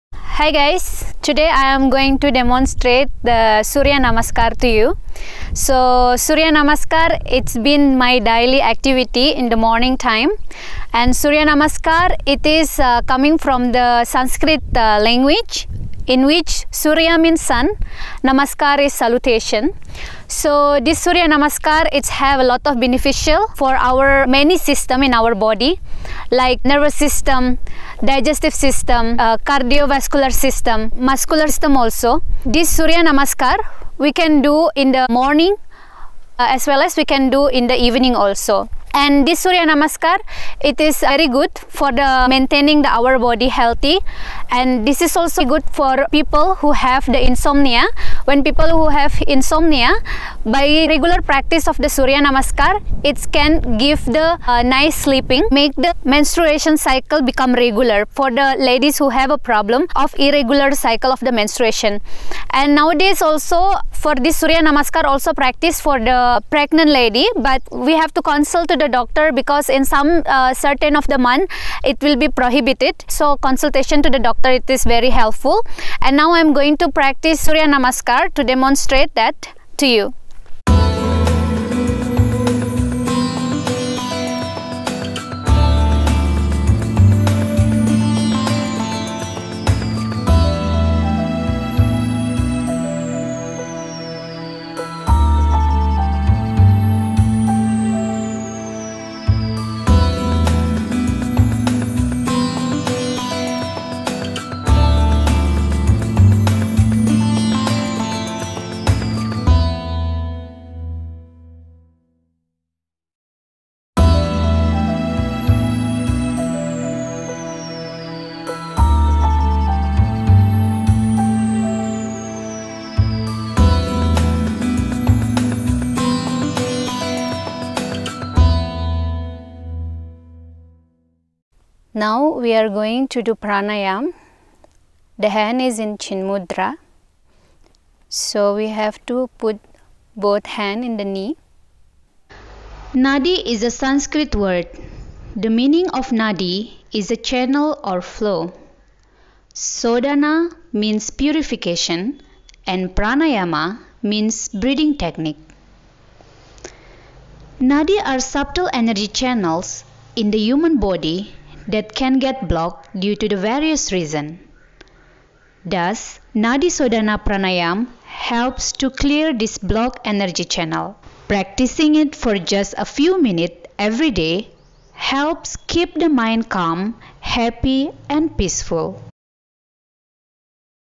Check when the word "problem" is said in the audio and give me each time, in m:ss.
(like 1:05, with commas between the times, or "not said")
0:59.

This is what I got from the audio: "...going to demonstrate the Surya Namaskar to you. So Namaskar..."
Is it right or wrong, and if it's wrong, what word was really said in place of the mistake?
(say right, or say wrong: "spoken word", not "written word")
wrong: "Surya", not "Namaskar".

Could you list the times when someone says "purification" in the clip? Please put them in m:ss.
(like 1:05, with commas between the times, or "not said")
2:31.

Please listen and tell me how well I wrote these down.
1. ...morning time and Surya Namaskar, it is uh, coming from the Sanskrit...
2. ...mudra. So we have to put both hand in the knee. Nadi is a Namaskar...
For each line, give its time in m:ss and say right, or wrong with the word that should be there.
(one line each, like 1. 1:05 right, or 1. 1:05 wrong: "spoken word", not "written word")
1. 0:09 right
2. 2:16 wrong: "Sanskrit", not "Namaskar".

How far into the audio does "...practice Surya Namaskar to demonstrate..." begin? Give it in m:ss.
1:16.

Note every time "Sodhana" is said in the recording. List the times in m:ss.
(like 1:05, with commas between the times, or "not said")
2:29, 2:46.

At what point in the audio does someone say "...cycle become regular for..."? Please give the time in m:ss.
0:56.